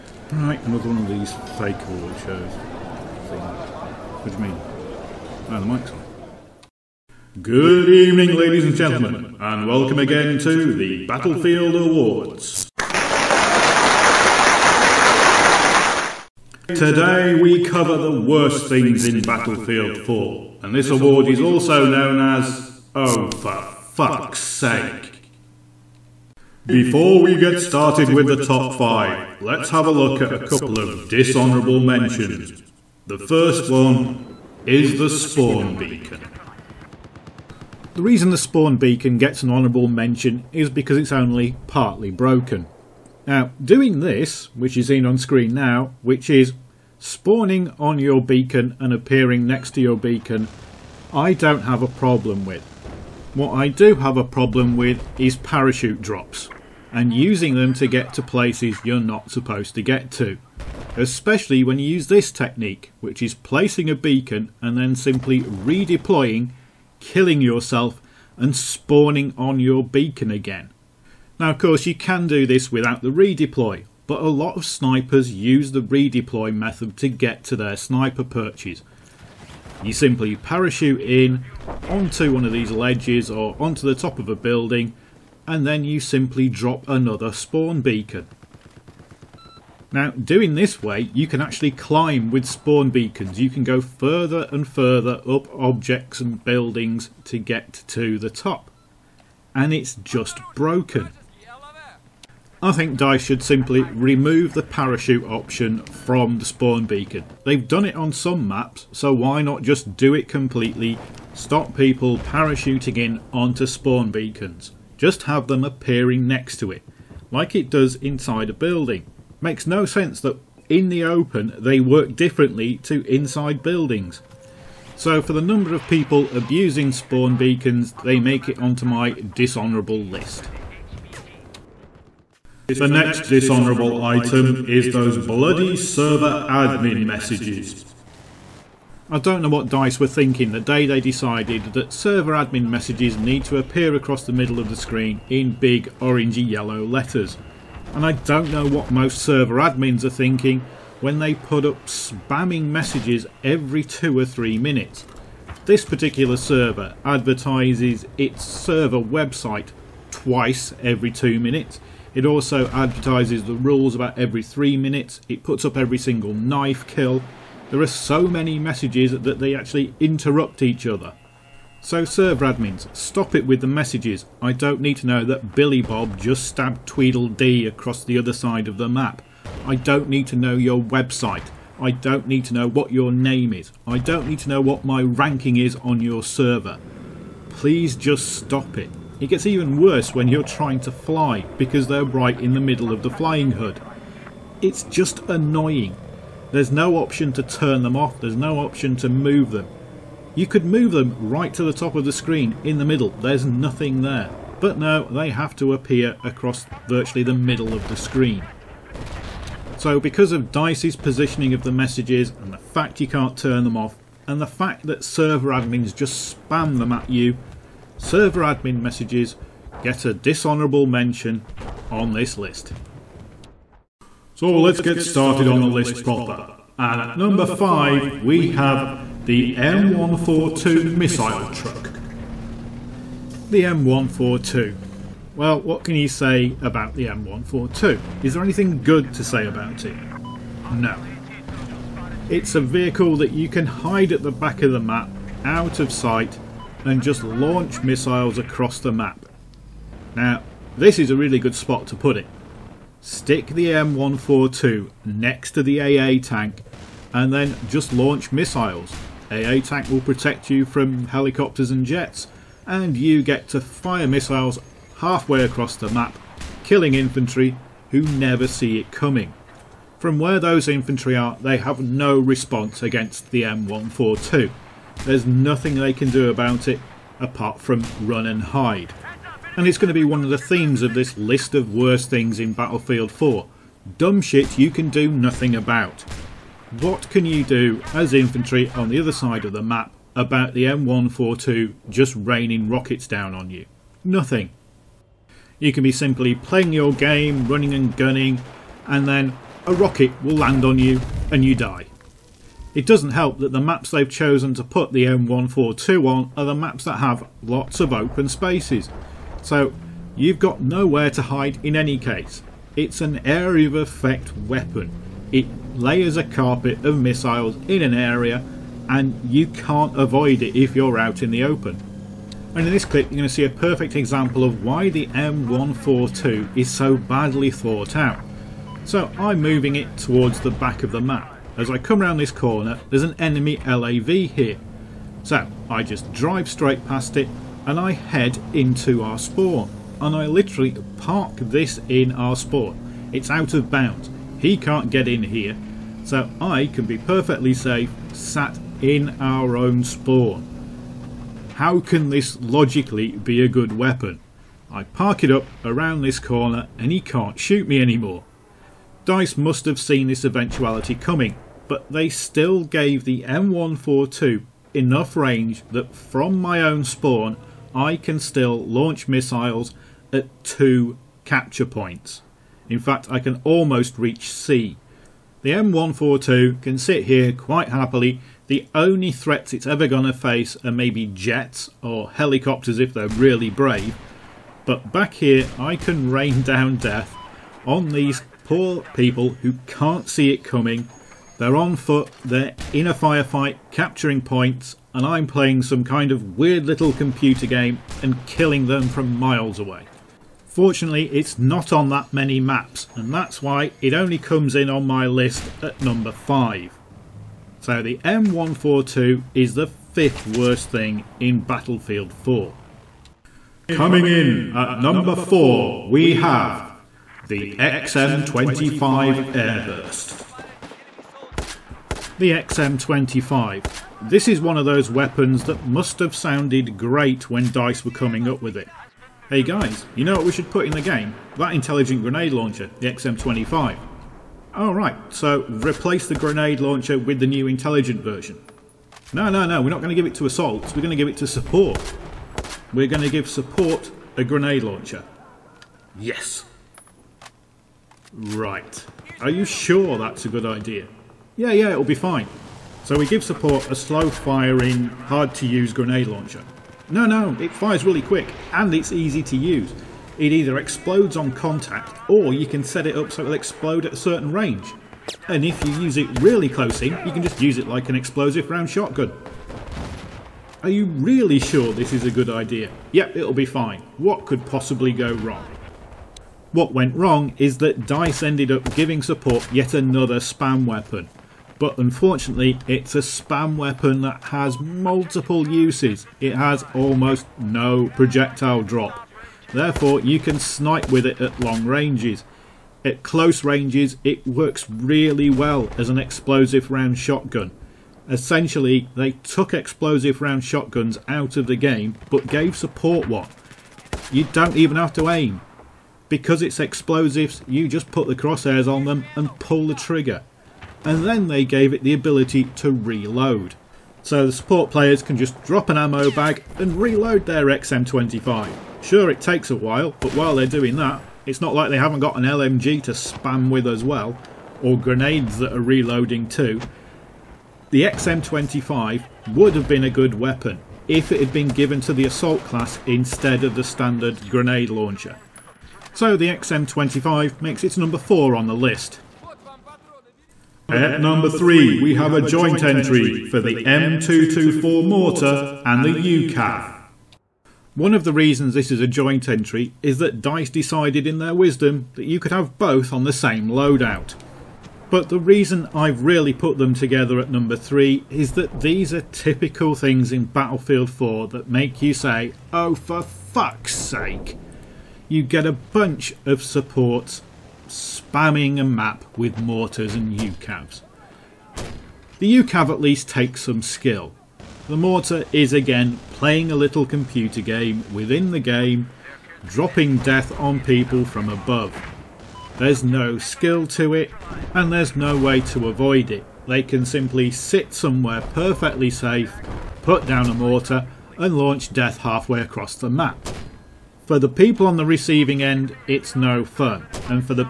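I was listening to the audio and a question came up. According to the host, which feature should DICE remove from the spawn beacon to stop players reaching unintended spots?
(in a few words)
parachute option.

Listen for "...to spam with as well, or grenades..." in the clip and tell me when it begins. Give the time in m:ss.
8:42.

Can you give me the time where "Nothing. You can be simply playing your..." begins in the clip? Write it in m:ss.
4:54.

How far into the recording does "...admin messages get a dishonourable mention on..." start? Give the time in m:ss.
3:38.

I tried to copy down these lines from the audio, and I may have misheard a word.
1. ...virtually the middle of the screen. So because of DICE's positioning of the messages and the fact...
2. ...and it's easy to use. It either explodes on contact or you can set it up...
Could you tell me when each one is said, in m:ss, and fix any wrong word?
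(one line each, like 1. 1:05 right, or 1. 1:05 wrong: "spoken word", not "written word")
1. 3:26 right
2. 7:38 right.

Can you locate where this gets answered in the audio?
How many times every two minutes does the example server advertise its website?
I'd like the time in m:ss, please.
2:40.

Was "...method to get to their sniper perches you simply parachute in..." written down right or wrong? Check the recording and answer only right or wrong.
right.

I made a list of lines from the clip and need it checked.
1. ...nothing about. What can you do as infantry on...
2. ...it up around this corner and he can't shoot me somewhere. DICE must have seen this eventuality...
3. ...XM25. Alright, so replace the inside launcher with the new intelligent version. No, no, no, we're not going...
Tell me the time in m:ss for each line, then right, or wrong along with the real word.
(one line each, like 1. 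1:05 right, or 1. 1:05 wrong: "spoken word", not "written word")
1. 4:45 right
2. 5:55 wrong: "anymore", not "somewhere"
3. 7:12 wrong: "grenade", not "inside".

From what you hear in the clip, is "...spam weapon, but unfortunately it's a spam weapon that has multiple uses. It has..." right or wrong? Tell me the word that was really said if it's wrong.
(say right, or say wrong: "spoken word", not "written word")
right.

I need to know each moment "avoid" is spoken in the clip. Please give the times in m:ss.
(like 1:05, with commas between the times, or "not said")
5:19, 9:45.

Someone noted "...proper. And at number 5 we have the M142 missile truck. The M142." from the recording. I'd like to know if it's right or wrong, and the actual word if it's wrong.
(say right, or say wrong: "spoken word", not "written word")
right.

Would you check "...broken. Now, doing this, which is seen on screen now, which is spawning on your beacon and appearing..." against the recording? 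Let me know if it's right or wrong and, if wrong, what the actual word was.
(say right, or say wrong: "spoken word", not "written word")
right.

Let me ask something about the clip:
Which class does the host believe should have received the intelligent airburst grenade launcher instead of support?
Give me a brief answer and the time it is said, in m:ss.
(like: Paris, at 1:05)
assault, at 8:52.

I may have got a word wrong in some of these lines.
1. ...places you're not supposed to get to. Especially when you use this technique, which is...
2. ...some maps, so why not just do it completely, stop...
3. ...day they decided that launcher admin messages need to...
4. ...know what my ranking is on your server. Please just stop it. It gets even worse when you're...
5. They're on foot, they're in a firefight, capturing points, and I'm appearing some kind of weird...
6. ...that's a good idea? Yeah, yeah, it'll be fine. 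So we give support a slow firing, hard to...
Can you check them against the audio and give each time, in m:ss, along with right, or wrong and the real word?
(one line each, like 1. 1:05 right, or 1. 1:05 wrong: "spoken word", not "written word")
1. 0:58 right
2. 1:48 right
3. 2:20 wrong: "server", not "launcher"
4. 3:04 right
5. 6:31 wrong: "playing", not "appearing"
6. 7:29 right.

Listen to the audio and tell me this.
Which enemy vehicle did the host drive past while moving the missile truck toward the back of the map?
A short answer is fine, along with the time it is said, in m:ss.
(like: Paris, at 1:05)
LAV, at 5:33.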